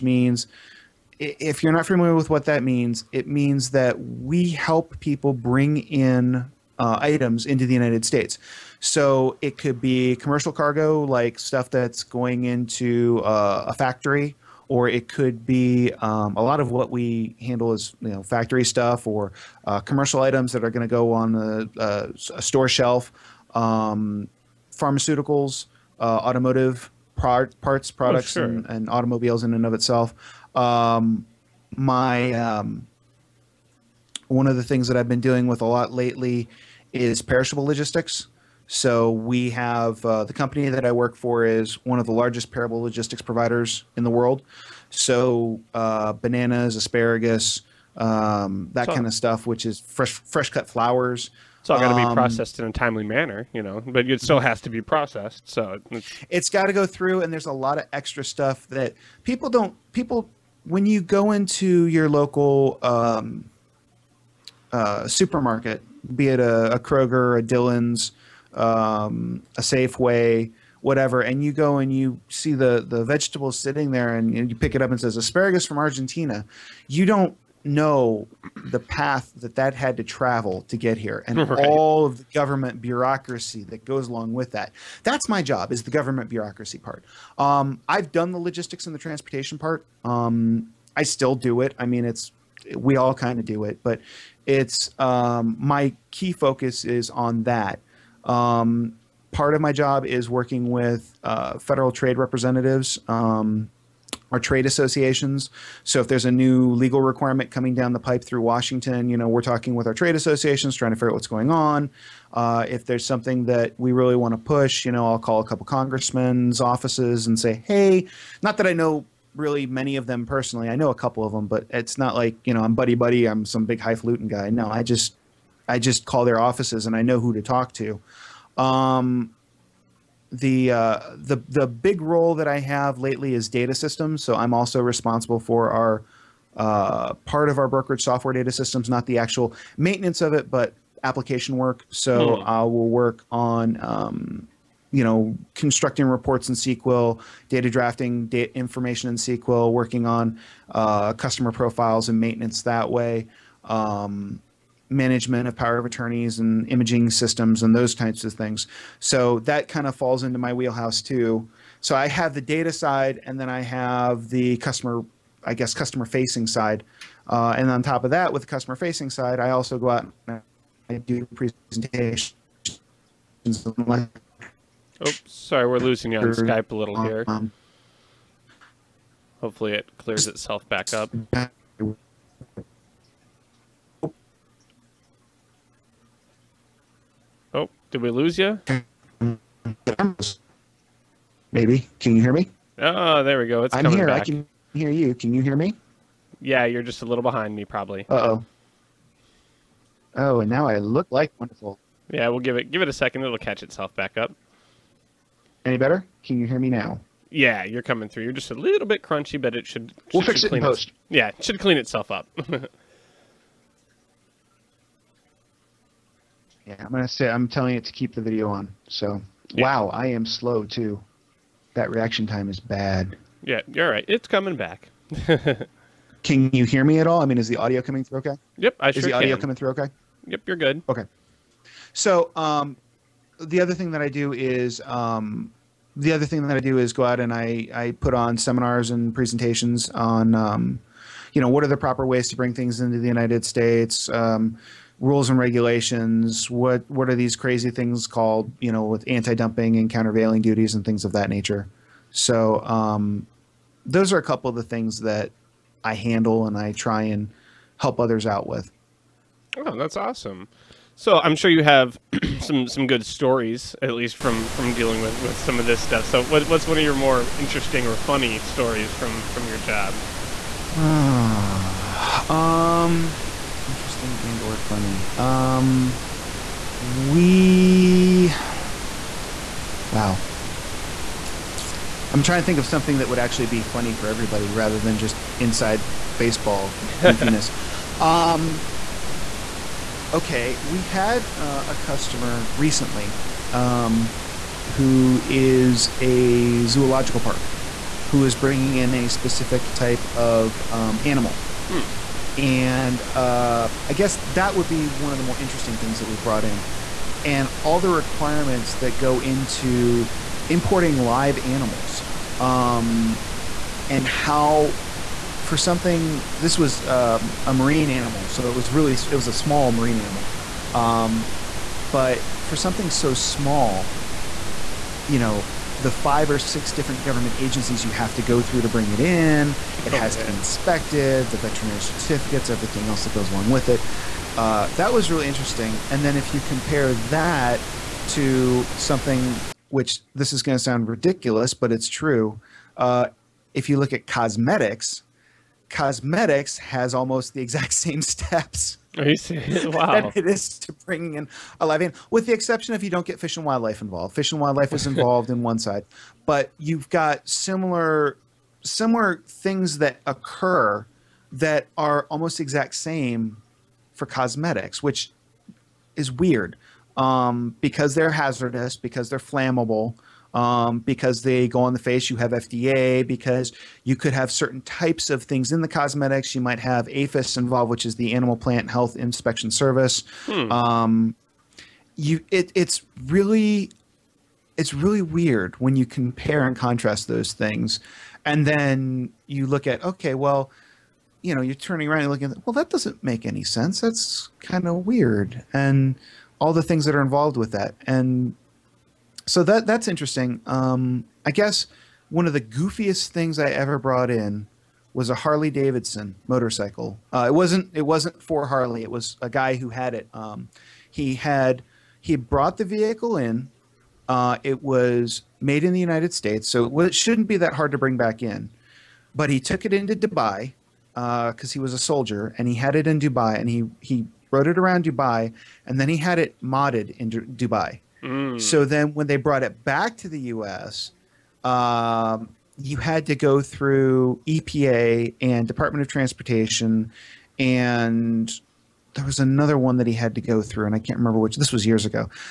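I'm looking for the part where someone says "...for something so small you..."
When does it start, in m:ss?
5:22.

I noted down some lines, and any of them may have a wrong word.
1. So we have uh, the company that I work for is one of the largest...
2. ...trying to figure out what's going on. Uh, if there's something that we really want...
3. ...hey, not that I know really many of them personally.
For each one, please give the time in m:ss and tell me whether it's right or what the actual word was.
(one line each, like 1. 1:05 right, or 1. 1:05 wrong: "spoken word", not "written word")
1. 0:38 right
2. 1:50 right
3. 1:57 right.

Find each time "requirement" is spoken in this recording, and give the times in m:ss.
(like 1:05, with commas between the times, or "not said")
1:47, 5:07.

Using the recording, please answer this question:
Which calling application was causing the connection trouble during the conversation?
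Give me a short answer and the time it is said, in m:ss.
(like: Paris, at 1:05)
Skype, at 2:56.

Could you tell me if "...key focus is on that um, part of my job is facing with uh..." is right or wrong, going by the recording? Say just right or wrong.
wrong.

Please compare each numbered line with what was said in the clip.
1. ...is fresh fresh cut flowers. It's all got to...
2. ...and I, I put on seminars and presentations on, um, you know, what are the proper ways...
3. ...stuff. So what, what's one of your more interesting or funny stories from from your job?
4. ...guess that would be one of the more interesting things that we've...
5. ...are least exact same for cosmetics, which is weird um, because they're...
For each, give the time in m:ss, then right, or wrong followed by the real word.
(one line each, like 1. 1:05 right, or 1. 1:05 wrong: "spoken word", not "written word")
1. 0:49 right
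2. 3:57 right
3. 4:25 right
4. 5:03 right
5. 6:01 wrong: "almost", not "least".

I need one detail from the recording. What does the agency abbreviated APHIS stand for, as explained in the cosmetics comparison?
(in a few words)
Animal Plant Health Inspection Service.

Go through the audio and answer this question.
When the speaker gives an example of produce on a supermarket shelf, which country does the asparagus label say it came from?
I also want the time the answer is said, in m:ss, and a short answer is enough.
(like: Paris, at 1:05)
Argentina, at 1:15.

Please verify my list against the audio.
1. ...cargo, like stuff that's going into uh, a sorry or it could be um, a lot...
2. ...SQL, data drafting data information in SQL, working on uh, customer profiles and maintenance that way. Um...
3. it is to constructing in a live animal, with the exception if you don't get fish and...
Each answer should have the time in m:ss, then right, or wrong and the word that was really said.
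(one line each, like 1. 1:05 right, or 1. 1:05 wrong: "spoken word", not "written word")
1. 0:10 wrong: "factory", not "sorry"
2. 2:26 right
3. 5:50 wrong: "bringing", not "constructing".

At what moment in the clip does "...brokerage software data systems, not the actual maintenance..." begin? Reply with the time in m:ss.
2:17.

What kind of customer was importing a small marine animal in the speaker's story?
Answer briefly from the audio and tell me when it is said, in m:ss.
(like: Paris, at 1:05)
A zoological park, at 4:56.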